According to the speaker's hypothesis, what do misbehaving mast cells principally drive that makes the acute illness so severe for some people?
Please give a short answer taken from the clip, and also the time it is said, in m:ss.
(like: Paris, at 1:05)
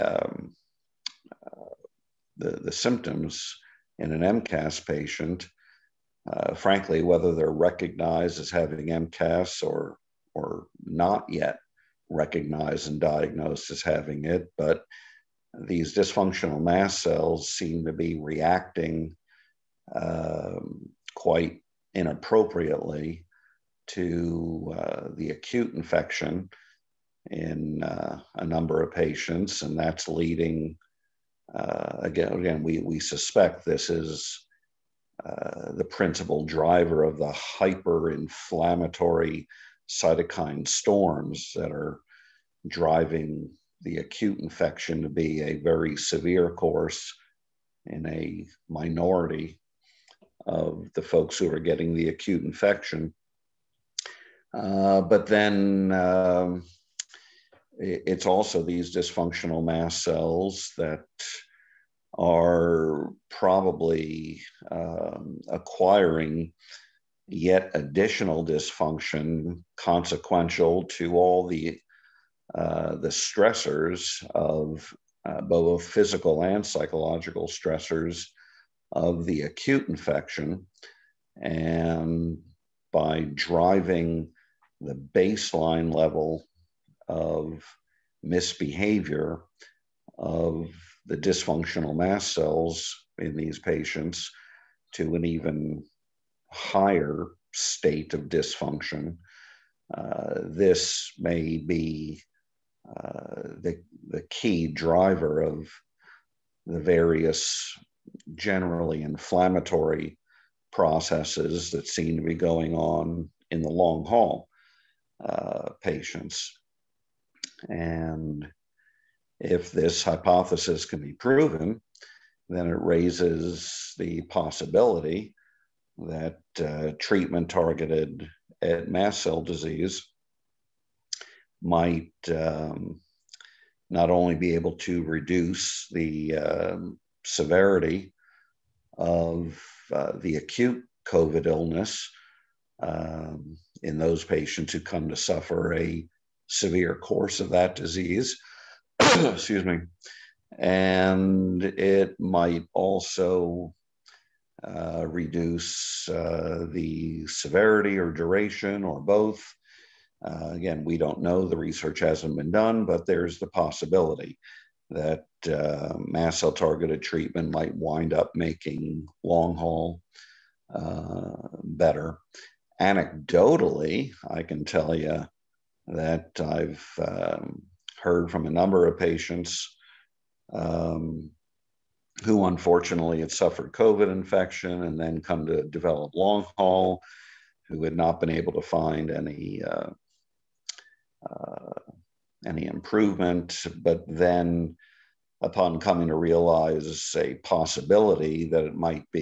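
hyperinflammatory cytokine storms, at 0:37.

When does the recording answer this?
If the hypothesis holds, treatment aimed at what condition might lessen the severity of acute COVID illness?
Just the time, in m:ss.
2:08.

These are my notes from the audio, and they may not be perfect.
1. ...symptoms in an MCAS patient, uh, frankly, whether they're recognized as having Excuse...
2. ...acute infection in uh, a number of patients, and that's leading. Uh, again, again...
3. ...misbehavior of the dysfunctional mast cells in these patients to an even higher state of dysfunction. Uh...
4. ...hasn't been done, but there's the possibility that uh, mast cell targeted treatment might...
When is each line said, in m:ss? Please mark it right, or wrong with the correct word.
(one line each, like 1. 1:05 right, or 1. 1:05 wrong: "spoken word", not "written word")
1. 0:02 wrong: "MCAS", not "Excuse"
2. 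0:25 right
3. 1:28 right
4. 2:42 right.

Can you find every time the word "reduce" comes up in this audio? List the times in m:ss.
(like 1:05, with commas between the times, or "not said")
2:15, 2:35.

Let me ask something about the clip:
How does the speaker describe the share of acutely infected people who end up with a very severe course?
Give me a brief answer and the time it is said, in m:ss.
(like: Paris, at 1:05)
a minority, at 0:48.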